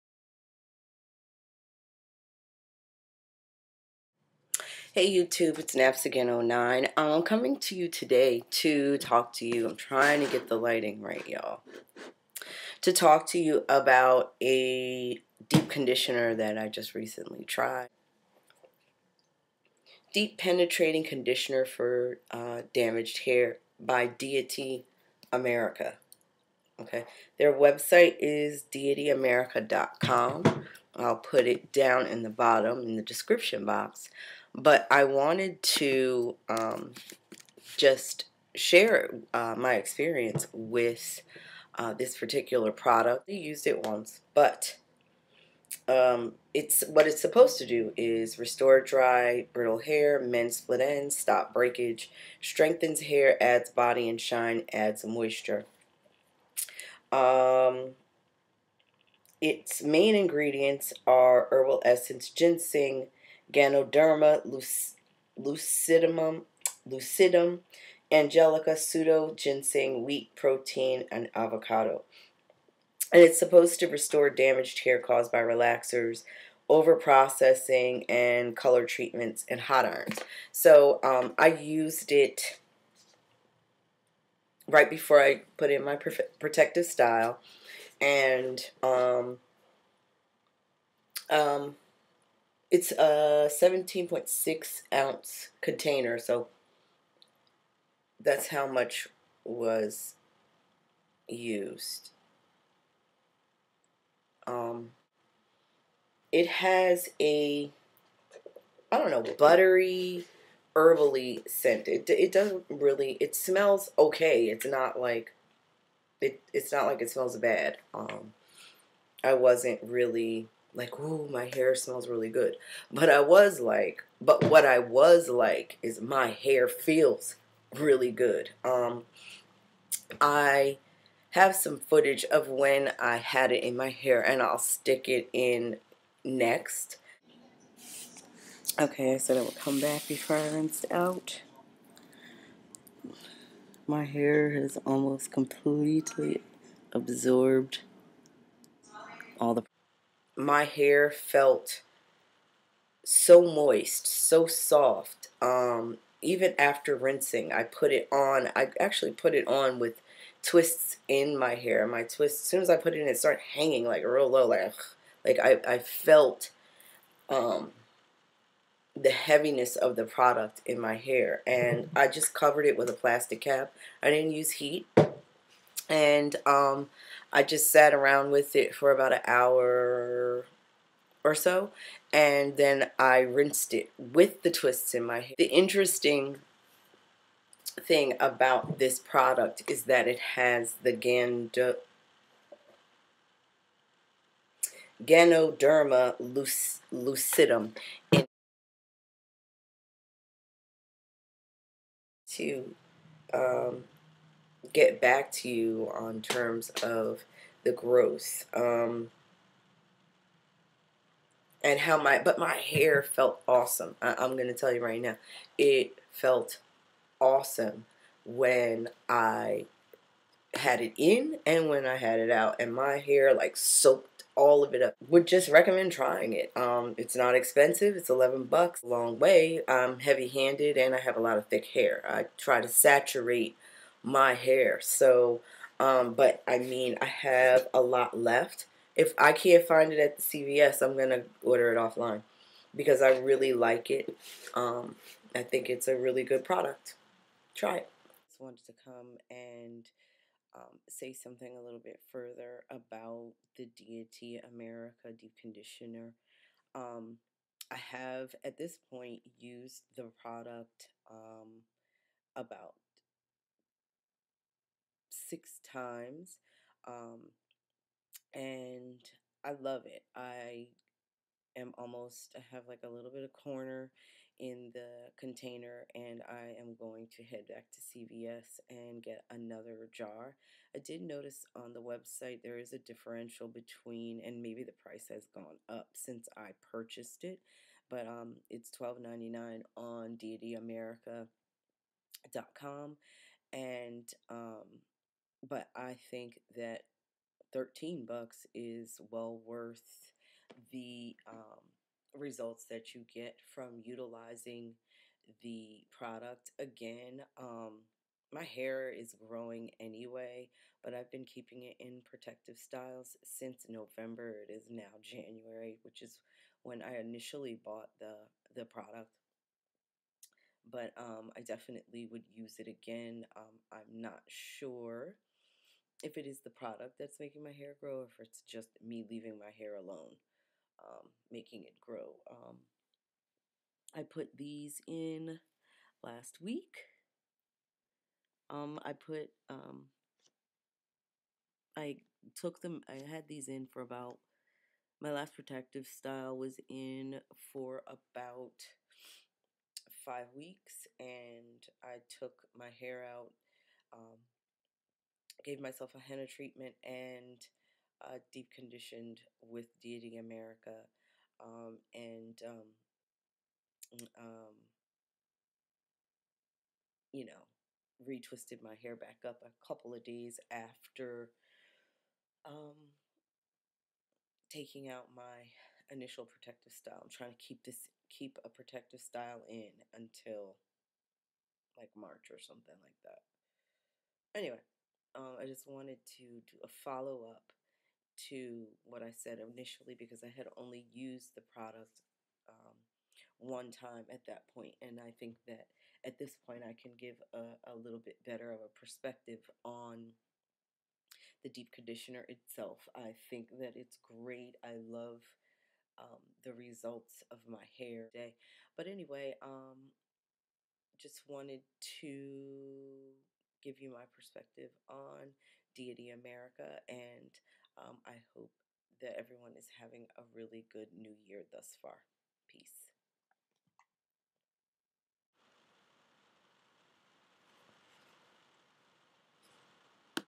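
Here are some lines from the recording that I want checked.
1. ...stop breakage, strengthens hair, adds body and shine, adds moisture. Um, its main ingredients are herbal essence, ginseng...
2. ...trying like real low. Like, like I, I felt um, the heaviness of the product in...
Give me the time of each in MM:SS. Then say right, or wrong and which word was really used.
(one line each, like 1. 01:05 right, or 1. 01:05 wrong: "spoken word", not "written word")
1. 00:51 right
2. 02:43 wrong: "hanging", not "trying".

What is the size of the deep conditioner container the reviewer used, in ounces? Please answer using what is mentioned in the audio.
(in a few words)
17.6 ounces.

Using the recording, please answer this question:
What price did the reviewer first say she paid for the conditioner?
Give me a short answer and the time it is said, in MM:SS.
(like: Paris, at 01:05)
$11, at 03:48.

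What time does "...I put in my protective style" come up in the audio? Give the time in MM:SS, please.
01:25.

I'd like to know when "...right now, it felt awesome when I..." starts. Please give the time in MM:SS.
03:34.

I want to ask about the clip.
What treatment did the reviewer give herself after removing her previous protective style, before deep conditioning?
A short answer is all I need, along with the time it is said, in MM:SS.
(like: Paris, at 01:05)
henna treatment, at 05:55.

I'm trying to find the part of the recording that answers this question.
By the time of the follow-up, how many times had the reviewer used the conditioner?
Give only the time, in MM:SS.
04:25.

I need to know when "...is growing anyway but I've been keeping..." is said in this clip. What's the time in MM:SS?
05:08.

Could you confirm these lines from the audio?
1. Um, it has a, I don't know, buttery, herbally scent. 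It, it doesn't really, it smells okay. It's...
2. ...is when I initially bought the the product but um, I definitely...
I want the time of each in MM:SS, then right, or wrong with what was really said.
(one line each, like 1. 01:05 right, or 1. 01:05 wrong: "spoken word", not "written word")
1. 01:44 right
2. 05:16 right.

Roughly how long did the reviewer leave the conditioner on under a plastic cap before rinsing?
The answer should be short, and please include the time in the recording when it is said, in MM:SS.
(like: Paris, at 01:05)
about an hour, at 02:58.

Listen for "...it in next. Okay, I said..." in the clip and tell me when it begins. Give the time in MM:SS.
02:15.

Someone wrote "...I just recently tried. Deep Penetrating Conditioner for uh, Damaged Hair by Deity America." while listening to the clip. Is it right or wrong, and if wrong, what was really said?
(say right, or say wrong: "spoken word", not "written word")
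right.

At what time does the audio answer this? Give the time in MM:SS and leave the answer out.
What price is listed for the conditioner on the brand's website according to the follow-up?
04:48.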